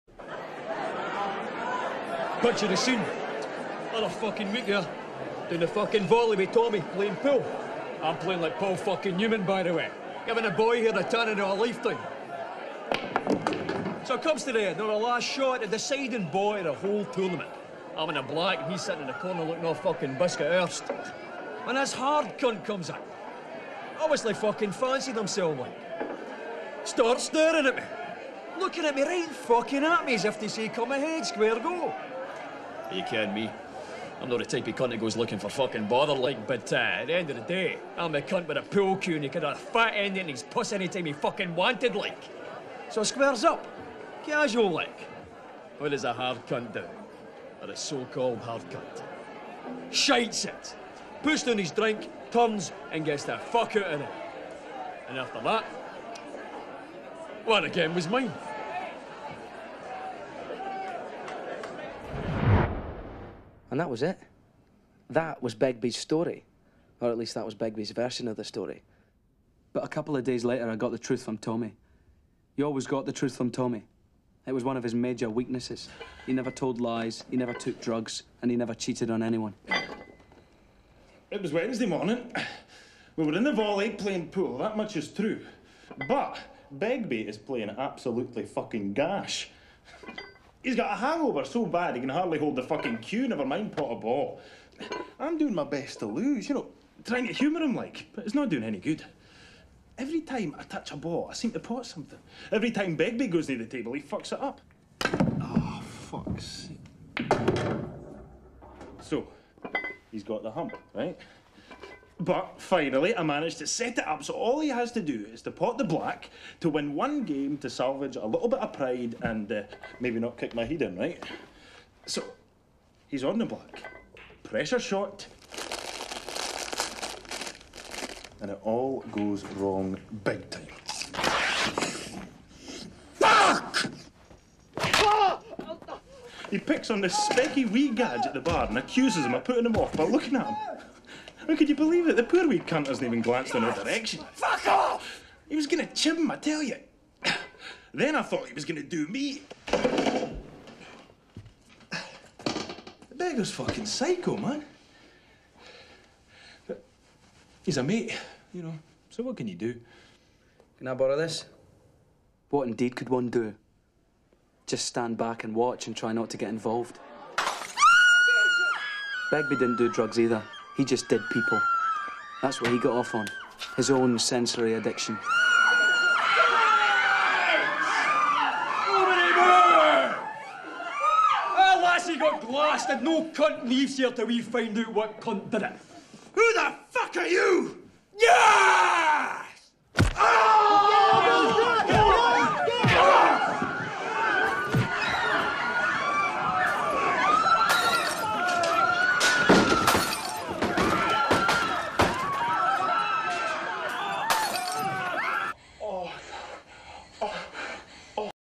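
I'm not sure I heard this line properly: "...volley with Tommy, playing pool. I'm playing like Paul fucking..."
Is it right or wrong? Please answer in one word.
right.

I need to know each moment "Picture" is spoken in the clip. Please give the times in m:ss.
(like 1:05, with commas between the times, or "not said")
0:02.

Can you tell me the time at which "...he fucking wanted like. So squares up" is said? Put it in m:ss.
0:41.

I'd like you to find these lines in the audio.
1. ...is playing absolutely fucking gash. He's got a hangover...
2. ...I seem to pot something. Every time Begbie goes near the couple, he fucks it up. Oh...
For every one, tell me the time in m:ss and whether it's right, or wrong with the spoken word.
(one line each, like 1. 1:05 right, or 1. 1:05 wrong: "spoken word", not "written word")
1. 1:27 right
2. 1:41 wrong: "table", not "couple".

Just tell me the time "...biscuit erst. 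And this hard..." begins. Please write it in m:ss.
0:20.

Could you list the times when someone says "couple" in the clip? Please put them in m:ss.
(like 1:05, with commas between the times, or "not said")
1:09.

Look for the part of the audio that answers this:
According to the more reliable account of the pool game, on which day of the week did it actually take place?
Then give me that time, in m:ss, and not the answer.
1:21.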